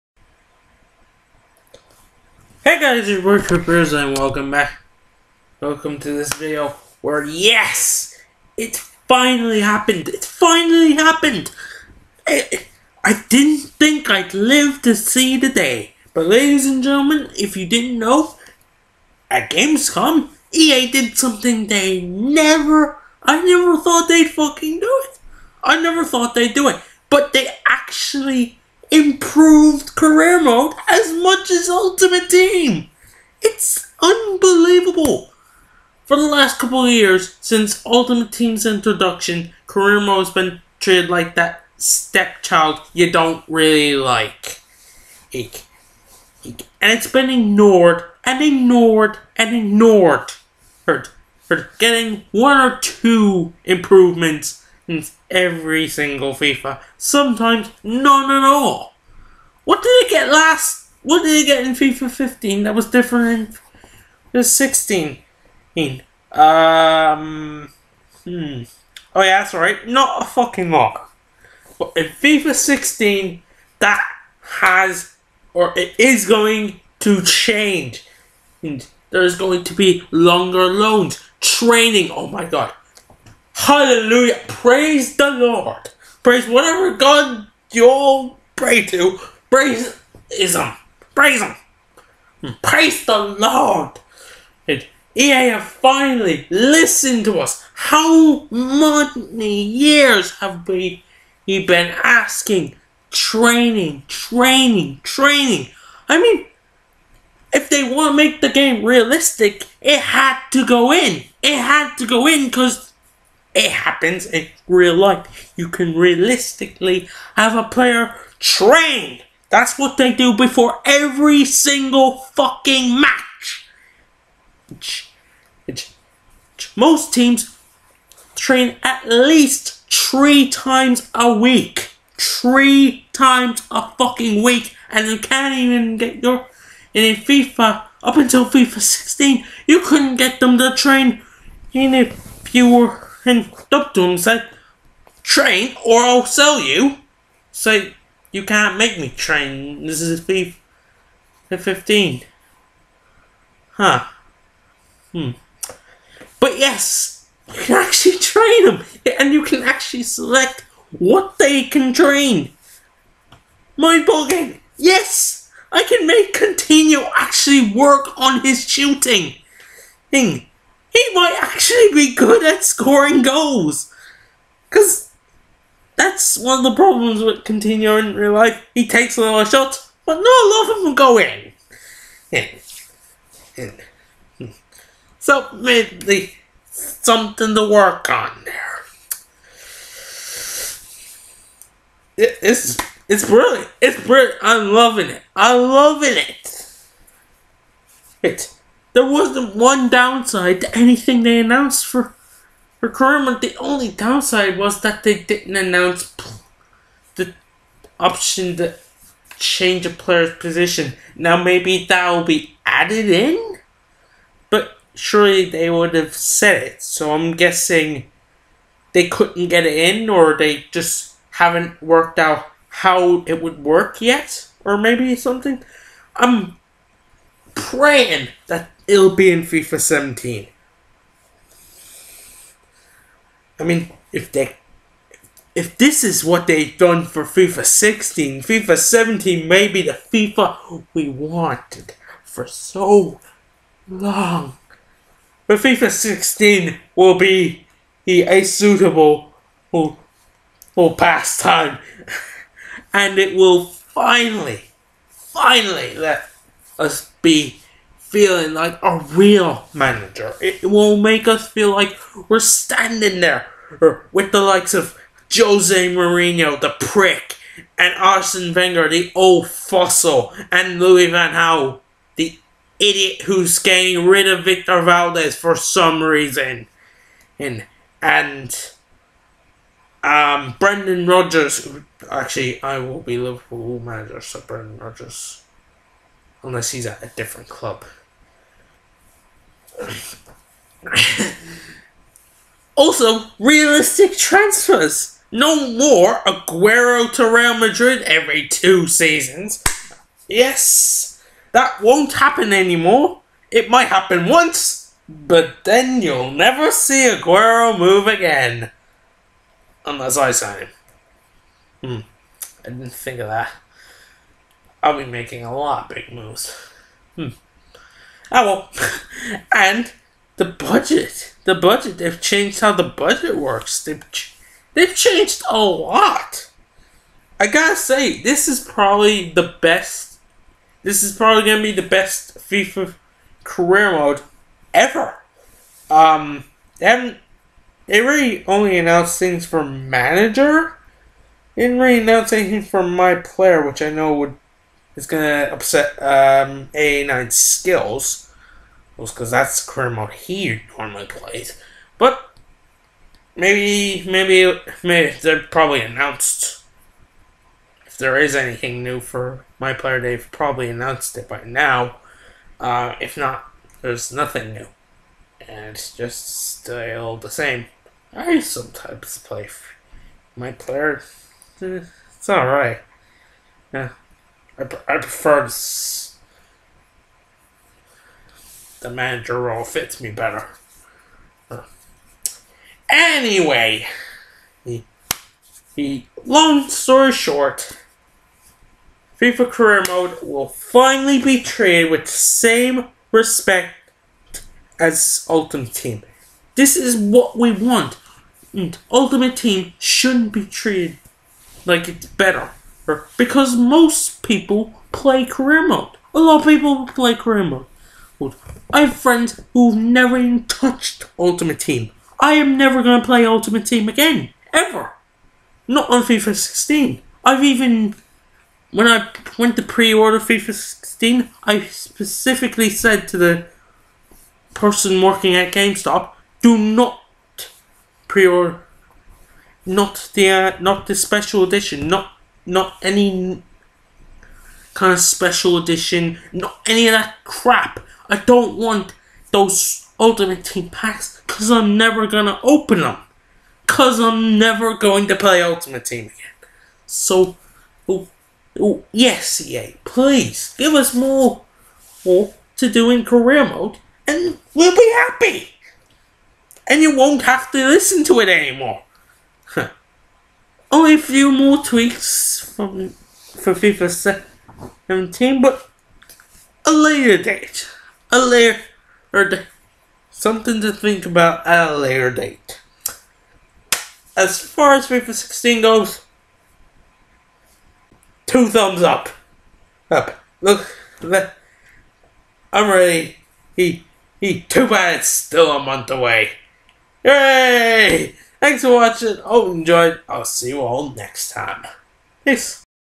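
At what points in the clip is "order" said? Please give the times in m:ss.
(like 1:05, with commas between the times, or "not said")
6:59, 7:08.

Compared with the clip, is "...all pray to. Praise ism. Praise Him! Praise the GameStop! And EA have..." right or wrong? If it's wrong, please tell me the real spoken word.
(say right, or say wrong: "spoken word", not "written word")
wrong: "Lord", not "GameStop".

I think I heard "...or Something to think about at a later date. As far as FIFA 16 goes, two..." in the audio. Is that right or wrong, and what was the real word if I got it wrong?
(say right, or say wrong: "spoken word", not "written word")
right.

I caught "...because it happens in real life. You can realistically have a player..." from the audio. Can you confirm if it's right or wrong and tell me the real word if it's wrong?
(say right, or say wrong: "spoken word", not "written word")
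right.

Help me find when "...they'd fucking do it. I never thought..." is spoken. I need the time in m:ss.
0:24.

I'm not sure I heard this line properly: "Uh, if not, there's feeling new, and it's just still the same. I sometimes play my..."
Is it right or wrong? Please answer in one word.
wrong.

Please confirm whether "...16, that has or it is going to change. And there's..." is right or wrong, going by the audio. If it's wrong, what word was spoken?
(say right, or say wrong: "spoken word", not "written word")
right.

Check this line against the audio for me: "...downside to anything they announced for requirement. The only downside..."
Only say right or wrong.
right.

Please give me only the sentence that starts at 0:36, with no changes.
For the last couple of years, since Ultimate Team's introduction, Career Mode has been treated like that stepchild you don't really like.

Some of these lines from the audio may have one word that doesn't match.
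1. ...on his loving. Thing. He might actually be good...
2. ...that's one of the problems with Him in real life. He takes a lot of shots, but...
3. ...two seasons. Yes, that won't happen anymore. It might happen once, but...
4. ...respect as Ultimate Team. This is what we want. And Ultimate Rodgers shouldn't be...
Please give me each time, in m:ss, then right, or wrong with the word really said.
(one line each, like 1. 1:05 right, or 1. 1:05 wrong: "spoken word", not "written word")
1. 2:48 wrong: "shooting", not "loving"
2. 2:56 wrong: "Coutinho", not "Him"
3. 4:58 right
4. 6:33 wrong: "Team", not "Rodgers".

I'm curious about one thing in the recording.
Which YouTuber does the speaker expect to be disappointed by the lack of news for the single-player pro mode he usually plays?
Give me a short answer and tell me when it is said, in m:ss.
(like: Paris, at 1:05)
A9 Skills, at 5:46.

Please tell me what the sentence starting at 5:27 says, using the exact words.
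I gotta say, this is probably the best.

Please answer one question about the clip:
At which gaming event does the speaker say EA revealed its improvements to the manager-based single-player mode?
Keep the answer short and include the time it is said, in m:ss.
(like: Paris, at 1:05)
Gamescom, at 0:19.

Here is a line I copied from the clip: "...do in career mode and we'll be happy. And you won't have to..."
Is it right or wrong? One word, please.
right.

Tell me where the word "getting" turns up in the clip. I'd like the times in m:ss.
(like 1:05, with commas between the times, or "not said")
0:51, 4:33.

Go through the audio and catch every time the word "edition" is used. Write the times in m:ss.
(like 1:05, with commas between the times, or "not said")
7:11, 7:15.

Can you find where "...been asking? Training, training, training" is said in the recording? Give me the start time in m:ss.
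1:41.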